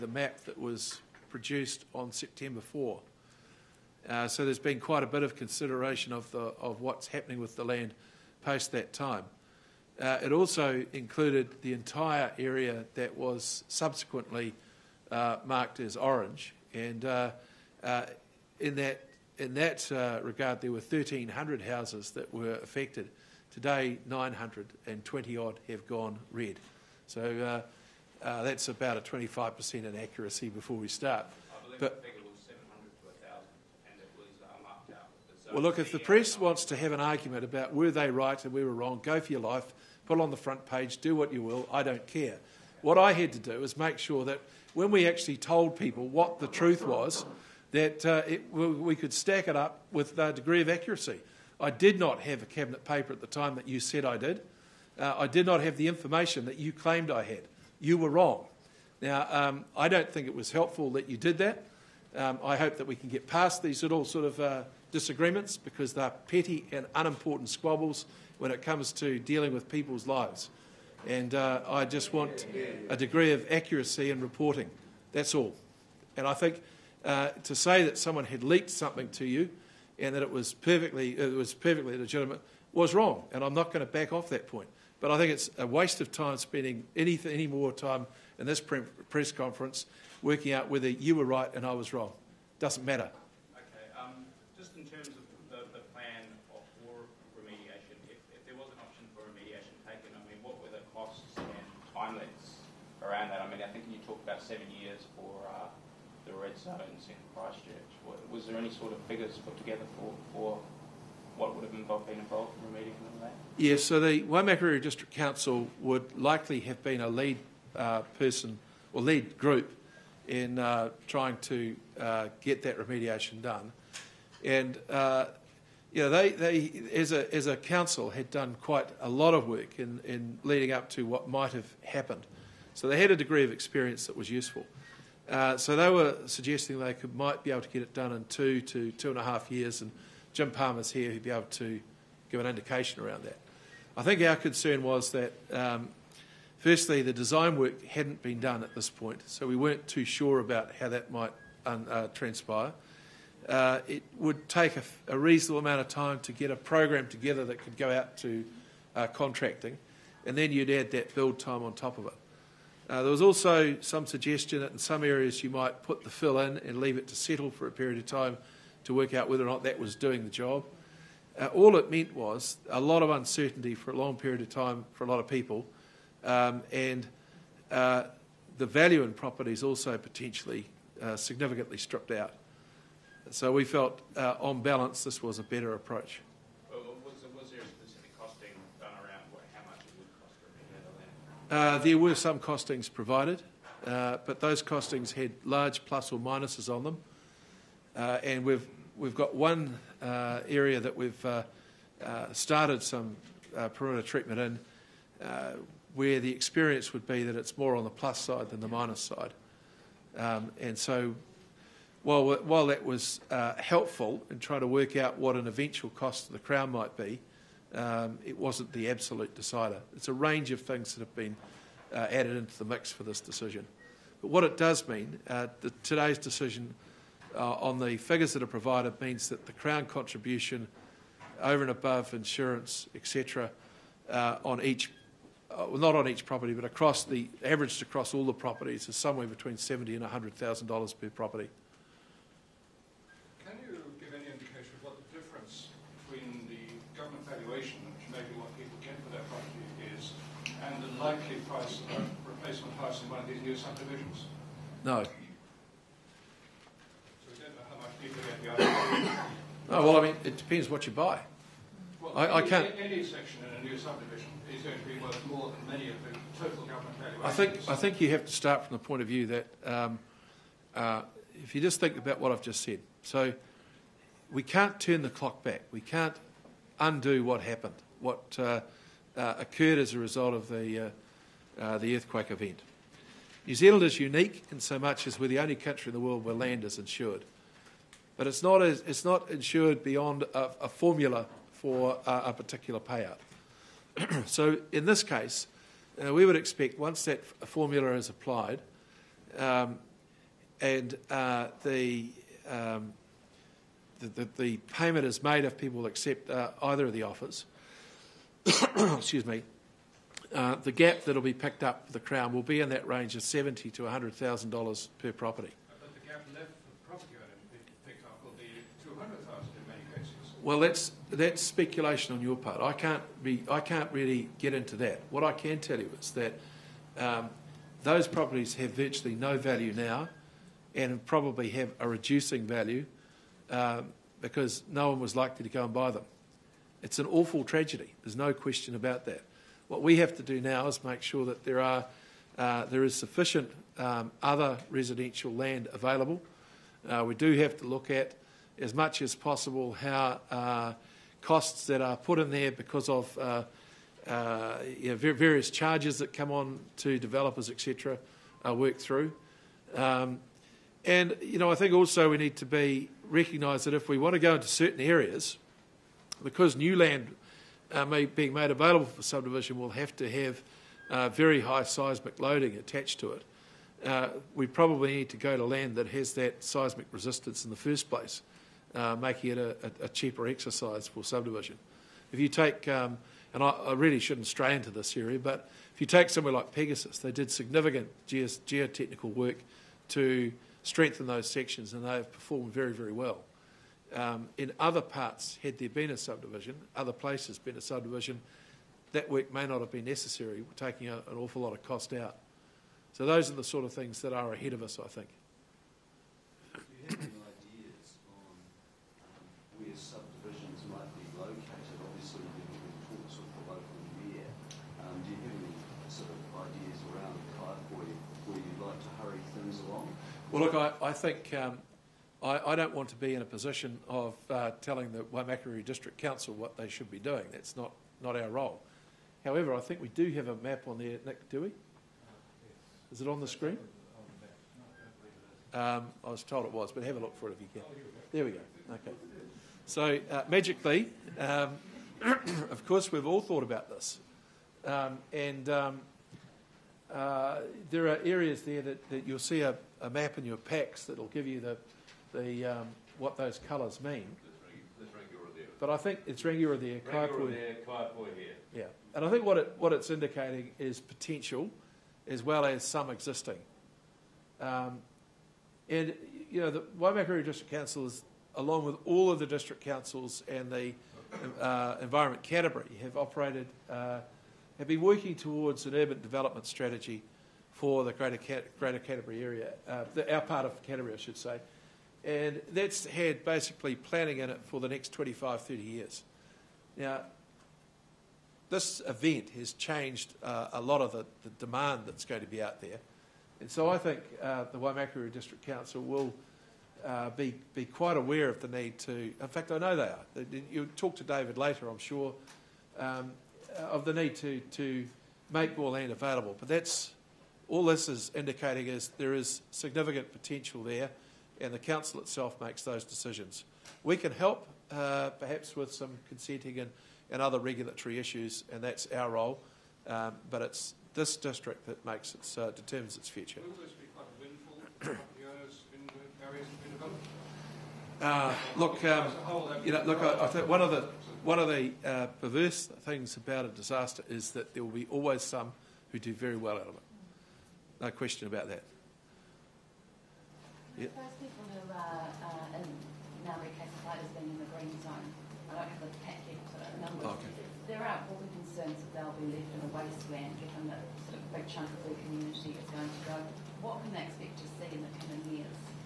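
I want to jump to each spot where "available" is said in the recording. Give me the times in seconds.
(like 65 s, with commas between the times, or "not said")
345 s, 368 s, 505 s.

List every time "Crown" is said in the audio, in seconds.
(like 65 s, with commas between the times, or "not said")
216 s, 229 s, 311 s.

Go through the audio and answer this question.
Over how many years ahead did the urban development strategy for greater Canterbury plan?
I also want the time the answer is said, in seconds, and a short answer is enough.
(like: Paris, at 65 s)
25 to 30 years, at 484 s.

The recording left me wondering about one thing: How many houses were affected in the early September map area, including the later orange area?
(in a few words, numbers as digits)
1,300.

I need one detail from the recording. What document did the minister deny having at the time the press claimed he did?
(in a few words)
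a cabinet paper.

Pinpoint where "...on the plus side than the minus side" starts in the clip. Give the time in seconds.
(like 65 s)
207 s.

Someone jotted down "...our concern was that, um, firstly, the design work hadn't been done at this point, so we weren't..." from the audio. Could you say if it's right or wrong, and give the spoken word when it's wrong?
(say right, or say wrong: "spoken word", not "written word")
right.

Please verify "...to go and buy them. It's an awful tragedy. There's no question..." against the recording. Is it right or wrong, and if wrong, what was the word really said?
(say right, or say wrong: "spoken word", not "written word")
right.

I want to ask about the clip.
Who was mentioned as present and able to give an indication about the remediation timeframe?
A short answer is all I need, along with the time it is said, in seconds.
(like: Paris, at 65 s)
Jim Palmer, at 140 s.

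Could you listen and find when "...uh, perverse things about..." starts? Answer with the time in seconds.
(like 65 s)
531 s.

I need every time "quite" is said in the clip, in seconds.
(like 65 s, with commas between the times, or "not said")
4 s, 128 s, 497 s.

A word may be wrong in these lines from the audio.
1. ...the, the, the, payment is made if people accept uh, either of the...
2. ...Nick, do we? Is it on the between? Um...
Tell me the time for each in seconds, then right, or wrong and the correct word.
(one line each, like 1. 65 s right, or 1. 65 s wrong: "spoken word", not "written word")
1. 304 s right
2. 431 s wrong: "screen", not "between".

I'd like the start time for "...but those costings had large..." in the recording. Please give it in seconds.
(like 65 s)
194 s.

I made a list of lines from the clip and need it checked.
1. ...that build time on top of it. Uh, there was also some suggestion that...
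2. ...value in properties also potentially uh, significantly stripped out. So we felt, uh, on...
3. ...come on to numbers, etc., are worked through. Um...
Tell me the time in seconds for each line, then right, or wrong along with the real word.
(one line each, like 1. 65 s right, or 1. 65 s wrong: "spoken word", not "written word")
1. 160 s right
2. 178 s right
3. 356 s wrong: "developers", not "numbers".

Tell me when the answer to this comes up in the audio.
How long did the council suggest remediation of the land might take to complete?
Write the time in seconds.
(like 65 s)
138 s.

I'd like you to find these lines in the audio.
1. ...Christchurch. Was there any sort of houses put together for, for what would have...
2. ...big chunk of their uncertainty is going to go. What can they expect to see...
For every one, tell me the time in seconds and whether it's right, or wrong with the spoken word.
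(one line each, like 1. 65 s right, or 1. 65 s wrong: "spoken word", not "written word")
1. 107 s wrong: "figures", not "houses"
2. 551 s wrong: "community", not "uncertainty".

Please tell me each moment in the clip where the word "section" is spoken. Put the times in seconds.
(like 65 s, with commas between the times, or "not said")
263 s, 391 s.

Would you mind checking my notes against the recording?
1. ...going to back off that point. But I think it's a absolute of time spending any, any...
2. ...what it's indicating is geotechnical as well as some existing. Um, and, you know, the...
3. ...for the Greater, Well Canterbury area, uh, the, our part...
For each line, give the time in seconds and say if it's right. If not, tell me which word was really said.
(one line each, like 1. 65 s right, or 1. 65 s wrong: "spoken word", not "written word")
1. 83 s wrong: "waste", not "absolute"
2. 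459 s wrong: "potential", not "geotechnical"
3. 477 s wrong: "Greater", not "Well".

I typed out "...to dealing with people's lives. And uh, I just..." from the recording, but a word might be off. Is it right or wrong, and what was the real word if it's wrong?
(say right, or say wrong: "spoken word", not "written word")
right.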